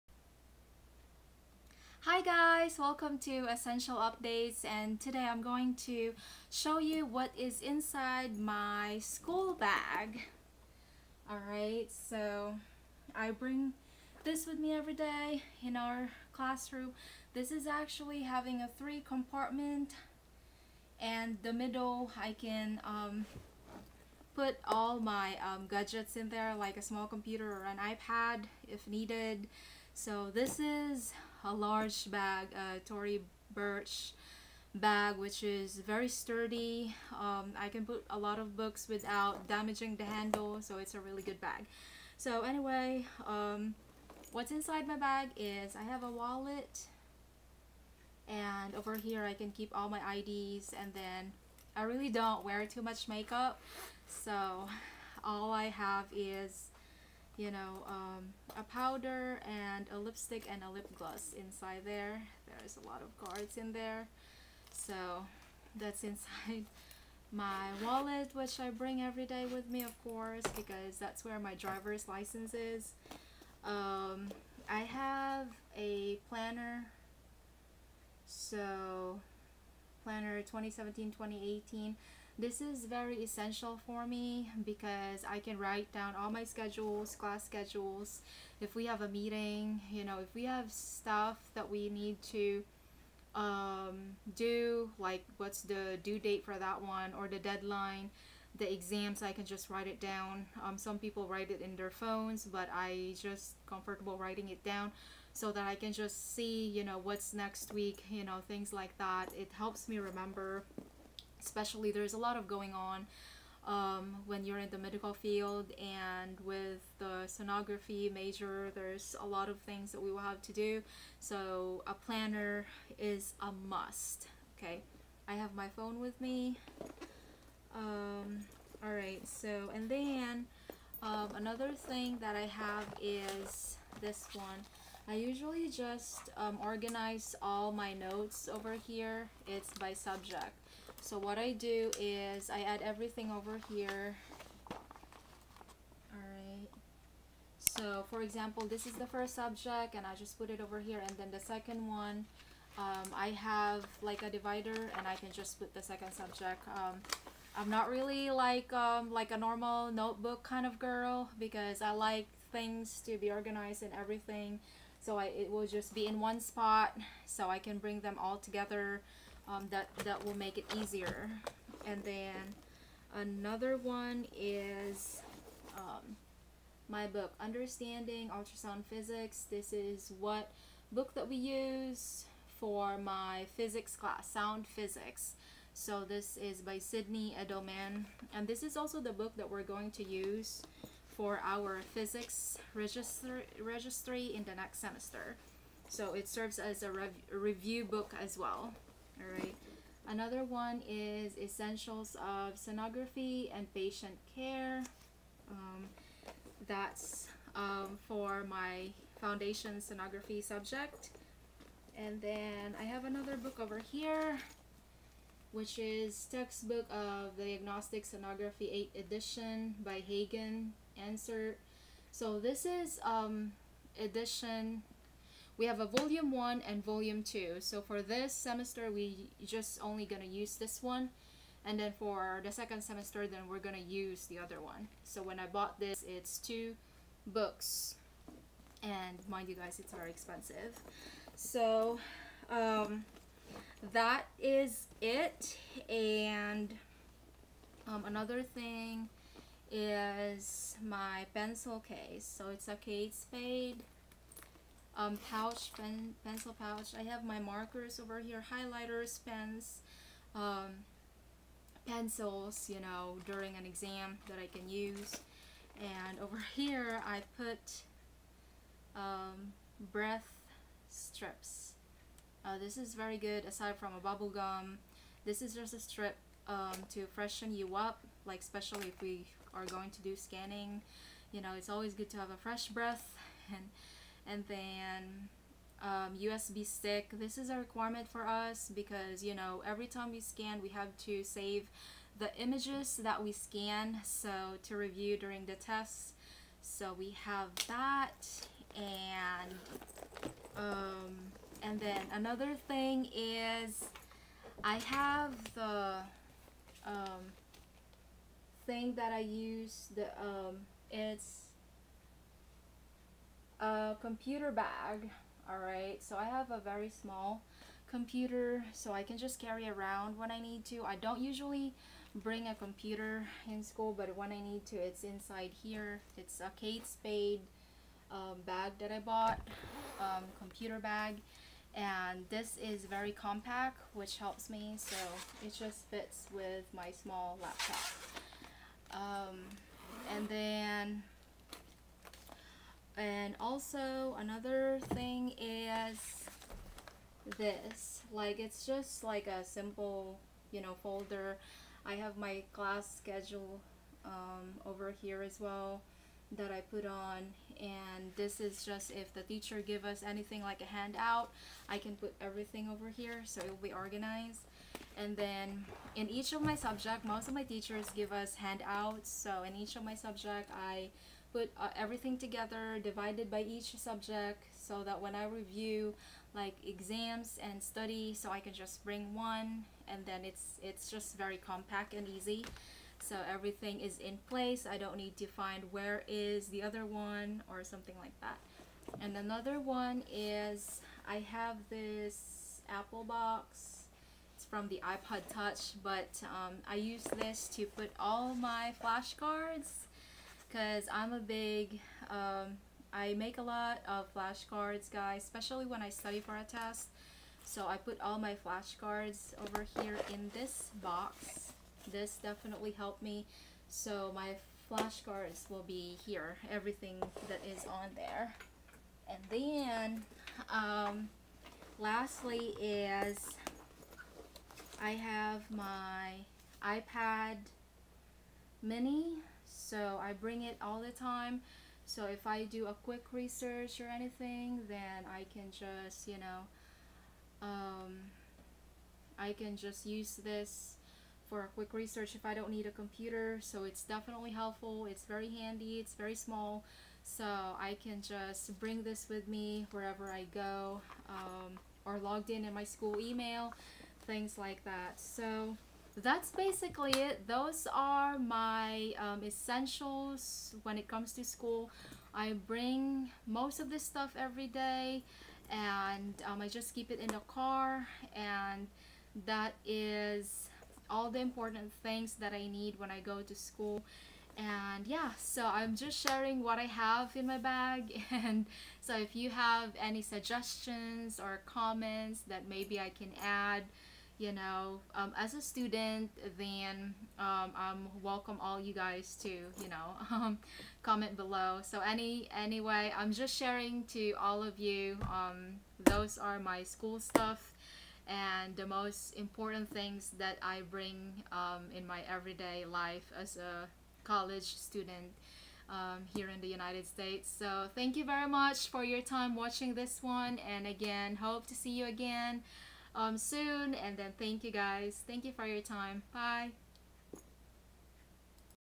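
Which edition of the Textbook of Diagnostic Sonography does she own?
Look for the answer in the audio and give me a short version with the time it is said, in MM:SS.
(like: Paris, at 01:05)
8th Edition, at 03:38.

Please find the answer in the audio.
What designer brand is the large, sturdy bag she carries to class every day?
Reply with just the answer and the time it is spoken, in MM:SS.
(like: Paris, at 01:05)
Tory Burch, at 00:32.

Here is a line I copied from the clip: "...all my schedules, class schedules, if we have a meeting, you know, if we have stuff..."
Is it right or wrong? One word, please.
right.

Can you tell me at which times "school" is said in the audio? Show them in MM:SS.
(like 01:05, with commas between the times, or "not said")
00:08, 05:23, 07:32, 07:41, 07:53, 08:16.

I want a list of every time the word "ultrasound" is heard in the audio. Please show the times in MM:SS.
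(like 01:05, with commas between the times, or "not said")
02:58.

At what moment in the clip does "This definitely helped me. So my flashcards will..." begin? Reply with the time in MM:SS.
06:51.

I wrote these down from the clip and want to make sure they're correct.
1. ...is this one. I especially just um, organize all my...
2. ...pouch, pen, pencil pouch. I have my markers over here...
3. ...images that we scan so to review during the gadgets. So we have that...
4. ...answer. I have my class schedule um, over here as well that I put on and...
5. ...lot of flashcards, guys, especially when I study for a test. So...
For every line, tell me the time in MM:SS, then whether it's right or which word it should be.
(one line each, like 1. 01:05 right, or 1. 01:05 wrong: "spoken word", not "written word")
1. 02:13 wrong: "usually", not "especially"
2. 04:15 right
3. 04:52 wrong: "tests", not "gadgets"
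4. 05:50 wrong: "folder", not "answer"
5. 06:43 right.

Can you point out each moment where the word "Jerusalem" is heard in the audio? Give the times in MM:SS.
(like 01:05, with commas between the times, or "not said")
not said.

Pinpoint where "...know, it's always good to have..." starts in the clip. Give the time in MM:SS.
04:41.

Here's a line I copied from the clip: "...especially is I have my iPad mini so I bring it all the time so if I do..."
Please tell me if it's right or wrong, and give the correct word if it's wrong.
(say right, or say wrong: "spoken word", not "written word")
wrong: "lastly", not "especially".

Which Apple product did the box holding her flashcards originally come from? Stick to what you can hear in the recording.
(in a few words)
iPod Touch.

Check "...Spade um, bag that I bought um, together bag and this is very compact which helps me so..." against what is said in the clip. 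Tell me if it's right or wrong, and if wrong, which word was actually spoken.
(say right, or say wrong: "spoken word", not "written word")
wrong: "computer", not "together".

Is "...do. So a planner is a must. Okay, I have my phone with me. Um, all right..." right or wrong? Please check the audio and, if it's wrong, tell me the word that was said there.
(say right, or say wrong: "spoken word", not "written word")
right.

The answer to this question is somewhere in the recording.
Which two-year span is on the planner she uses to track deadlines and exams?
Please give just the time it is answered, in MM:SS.
01:20.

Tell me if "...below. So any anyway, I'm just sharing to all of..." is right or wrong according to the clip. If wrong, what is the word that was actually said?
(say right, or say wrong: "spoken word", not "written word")
right.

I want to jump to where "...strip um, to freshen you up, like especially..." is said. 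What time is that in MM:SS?
04:35.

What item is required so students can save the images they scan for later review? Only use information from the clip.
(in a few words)
USB stick.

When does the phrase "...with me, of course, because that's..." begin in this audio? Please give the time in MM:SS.
01:09.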